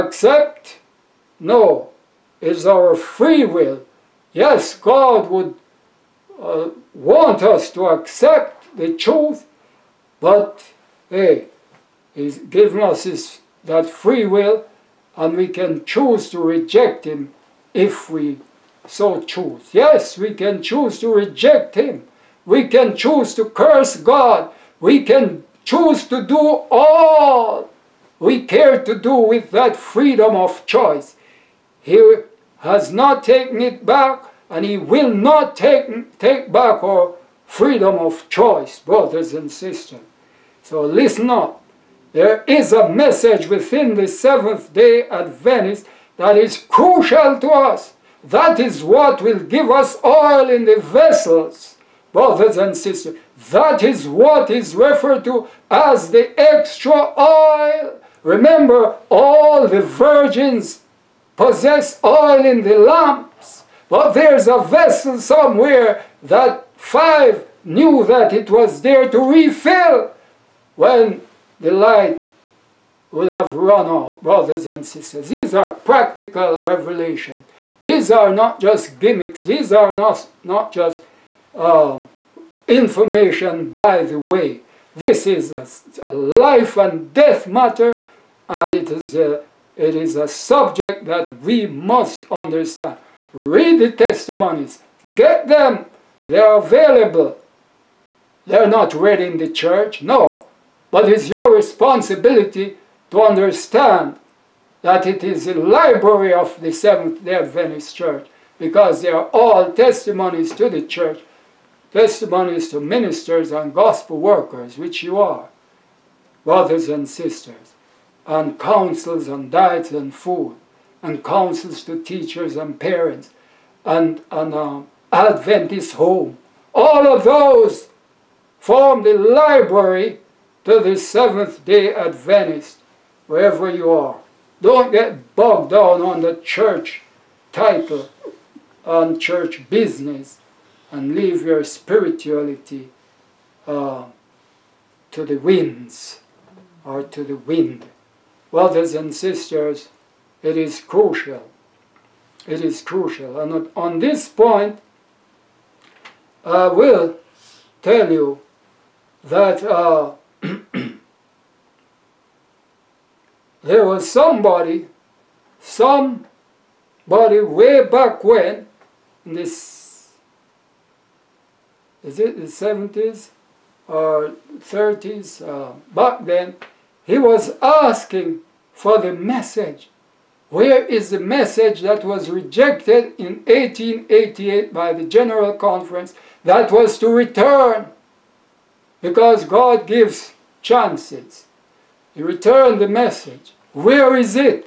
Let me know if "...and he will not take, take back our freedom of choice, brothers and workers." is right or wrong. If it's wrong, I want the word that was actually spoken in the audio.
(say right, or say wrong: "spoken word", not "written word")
wrong: "sisters", not "workers".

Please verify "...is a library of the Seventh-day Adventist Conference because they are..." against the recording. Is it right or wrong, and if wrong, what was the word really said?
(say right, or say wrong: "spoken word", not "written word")
wrong: "Church", not "Conference".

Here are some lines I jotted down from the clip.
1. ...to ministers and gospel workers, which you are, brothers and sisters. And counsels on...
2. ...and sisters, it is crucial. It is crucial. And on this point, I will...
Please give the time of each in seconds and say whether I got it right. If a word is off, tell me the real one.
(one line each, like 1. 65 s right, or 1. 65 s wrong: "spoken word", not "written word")
1. 112 s right
2. 148 s right.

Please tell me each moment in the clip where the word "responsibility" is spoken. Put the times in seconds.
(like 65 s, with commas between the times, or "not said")
101 s.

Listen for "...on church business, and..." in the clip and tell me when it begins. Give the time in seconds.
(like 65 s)
138 s.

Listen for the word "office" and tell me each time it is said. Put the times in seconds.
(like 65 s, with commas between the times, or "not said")
not said.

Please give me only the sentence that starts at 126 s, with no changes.
All of those form the library to the Seventh-day Adventist, wherever you are.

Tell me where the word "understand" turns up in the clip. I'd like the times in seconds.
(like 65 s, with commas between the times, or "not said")
92 s, 103 s.